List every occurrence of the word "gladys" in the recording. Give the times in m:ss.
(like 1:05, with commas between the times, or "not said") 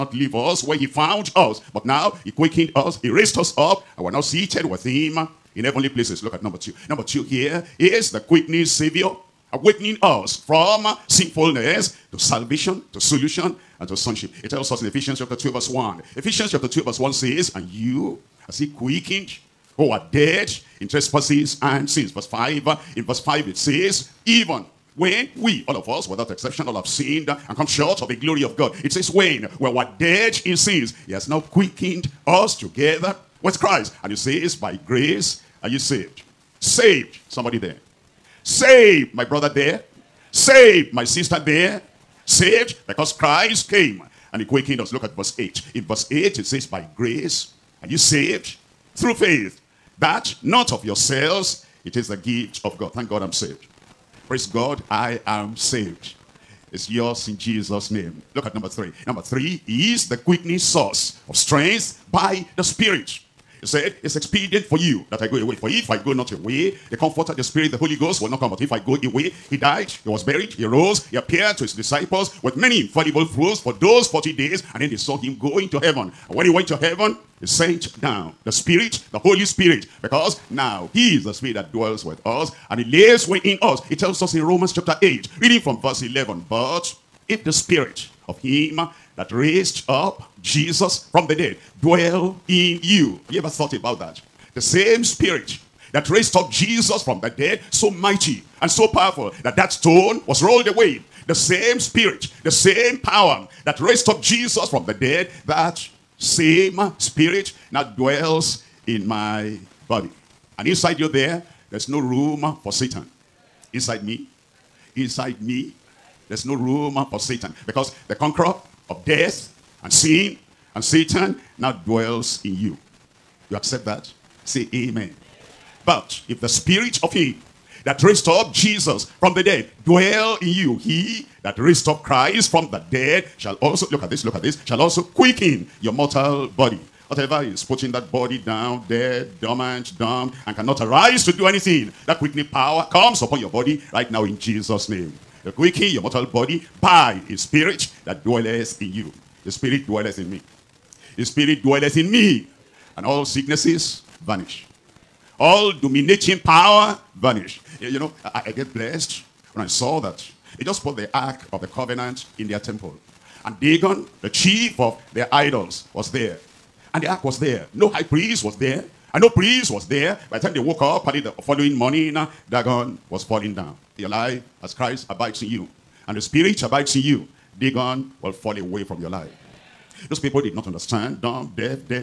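not said.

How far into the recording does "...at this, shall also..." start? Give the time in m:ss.
2:14.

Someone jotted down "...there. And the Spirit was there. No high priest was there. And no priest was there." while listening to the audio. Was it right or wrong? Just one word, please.
wrong.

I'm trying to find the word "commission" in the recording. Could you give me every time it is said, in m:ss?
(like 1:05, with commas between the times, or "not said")
not said.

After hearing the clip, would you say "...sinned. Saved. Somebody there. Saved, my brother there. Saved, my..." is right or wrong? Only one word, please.
wrong.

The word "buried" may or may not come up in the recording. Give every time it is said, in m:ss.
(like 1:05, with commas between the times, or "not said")
1:10.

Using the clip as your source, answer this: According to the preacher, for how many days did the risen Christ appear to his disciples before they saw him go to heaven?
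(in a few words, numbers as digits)
40.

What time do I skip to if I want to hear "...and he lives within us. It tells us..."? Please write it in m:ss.
1:22.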